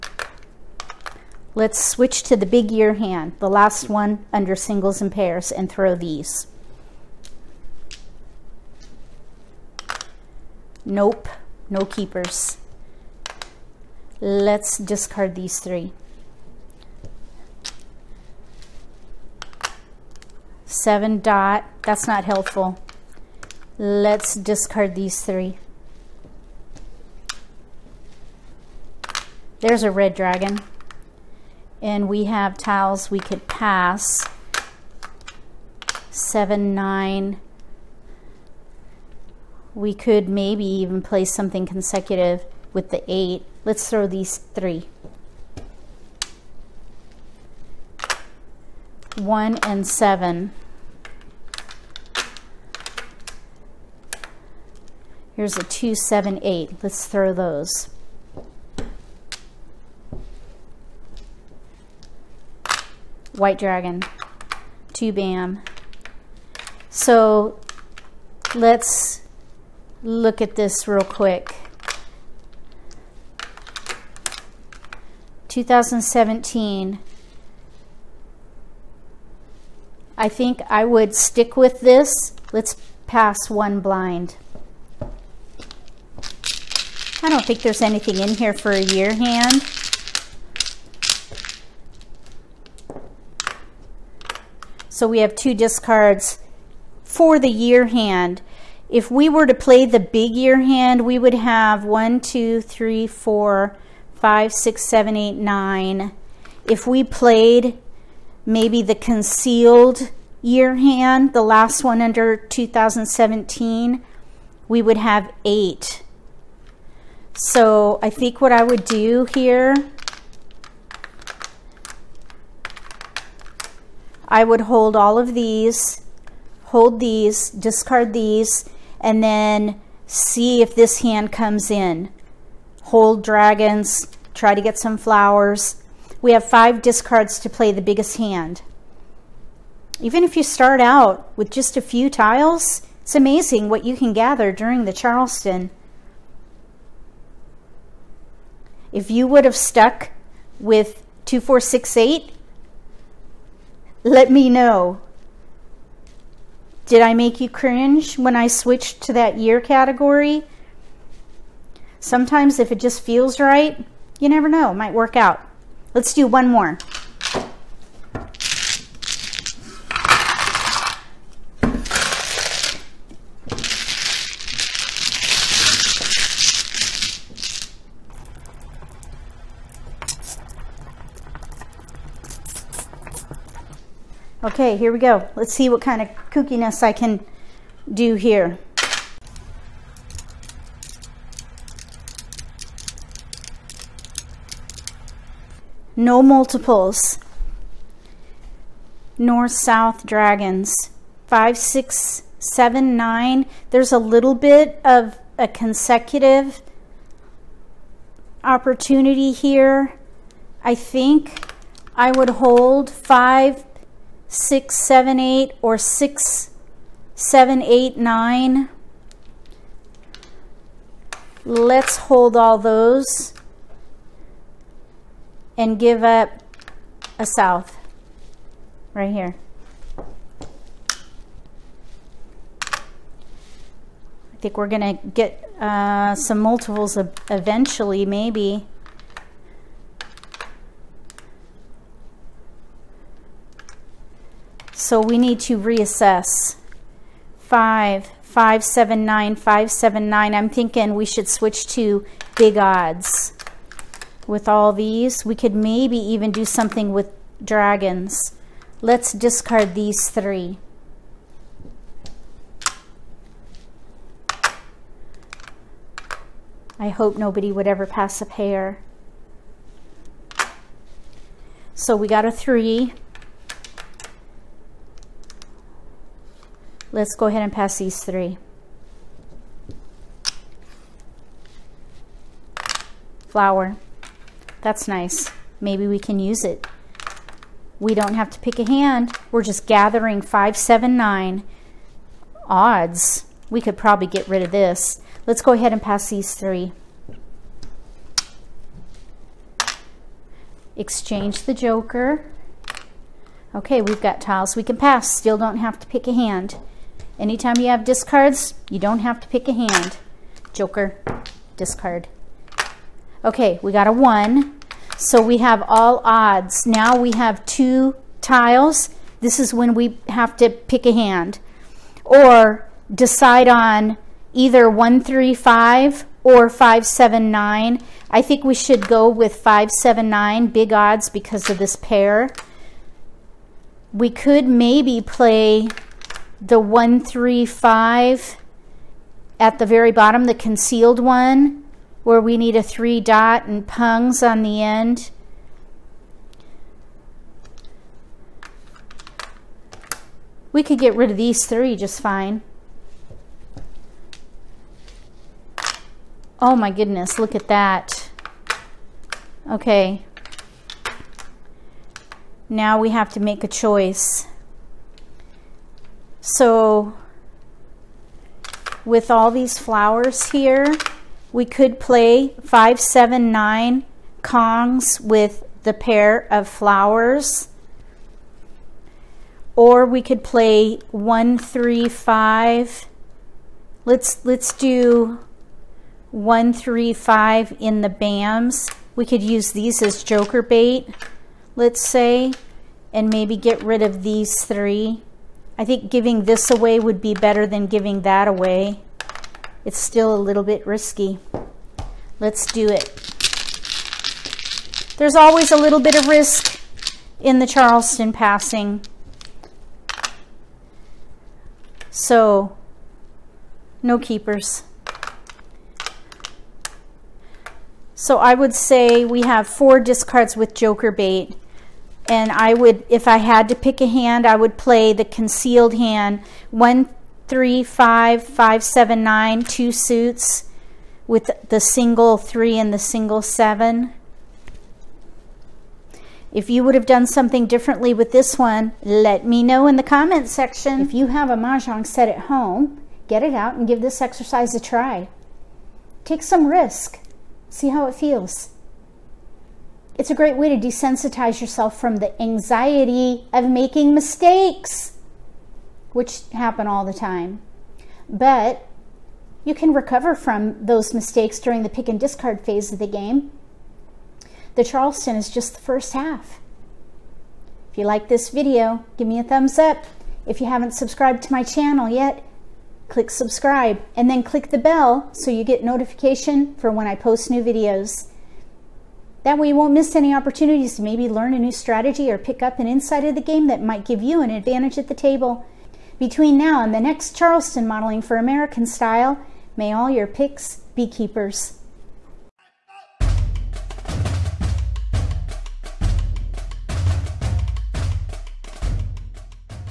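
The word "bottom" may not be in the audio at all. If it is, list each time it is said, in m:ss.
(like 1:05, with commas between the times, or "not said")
5:39.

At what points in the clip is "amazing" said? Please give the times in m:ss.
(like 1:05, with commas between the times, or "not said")
2:23.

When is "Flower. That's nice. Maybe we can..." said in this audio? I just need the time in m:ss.
4:43.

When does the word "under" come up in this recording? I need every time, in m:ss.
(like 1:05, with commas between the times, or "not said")
0:04, 1:52.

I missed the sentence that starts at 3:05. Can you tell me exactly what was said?
Let's see what kind of kookiness I can do here.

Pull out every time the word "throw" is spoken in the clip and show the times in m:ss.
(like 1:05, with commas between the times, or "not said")
0:05, 0:43, 0:57.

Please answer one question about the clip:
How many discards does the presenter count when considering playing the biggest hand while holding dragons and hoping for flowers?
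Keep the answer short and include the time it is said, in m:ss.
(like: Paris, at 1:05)
5, at 2:16.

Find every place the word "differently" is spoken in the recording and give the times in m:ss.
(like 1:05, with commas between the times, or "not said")
7:17.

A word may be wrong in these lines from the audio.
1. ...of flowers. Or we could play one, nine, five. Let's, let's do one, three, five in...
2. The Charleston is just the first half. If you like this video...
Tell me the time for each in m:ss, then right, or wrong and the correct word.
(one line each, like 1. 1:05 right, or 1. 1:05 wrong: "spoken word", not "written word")
1. 6:16 wrong: "three", not "nine"
2. 7:44 right.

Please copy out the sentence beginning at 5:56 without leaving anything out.
Oh my goodness, look at that.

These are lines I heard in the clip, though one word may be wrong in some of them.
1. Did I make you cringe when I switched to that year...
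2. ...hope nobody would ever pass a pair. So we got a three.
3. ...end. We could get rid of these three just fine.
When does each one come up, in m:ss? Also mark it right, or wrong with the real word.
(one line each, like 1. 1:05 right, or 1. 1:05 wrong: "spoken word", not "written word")
1. 2:36 right
2. 4:26 right
3. 5:44 right.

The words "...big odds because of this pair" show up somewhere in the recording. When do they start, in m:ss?
5:30.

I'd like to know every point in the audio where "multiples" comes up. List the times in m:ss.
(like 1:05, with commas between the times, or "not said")
3:16, 3:56.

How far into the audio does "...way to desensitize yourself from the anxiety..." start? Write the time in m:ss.
7:30.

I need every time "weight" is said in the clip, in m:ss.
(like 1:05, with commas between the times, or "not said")
not said.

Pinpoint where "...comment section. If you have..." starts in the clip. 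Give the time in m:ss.
7:19.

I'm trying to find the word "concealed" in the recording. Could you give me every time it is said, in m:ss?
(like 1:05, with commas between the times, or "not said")
1:48, 5:40, 7:05.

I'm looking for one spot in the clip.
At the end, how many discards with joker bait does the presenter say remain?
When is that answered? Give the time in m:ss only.
6:59.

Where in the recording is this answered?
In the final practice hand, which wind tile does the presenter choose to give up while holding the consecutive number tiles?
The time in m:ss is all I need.
3:47.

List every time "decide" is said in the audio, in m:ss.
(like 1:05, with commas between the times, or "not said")
5:22.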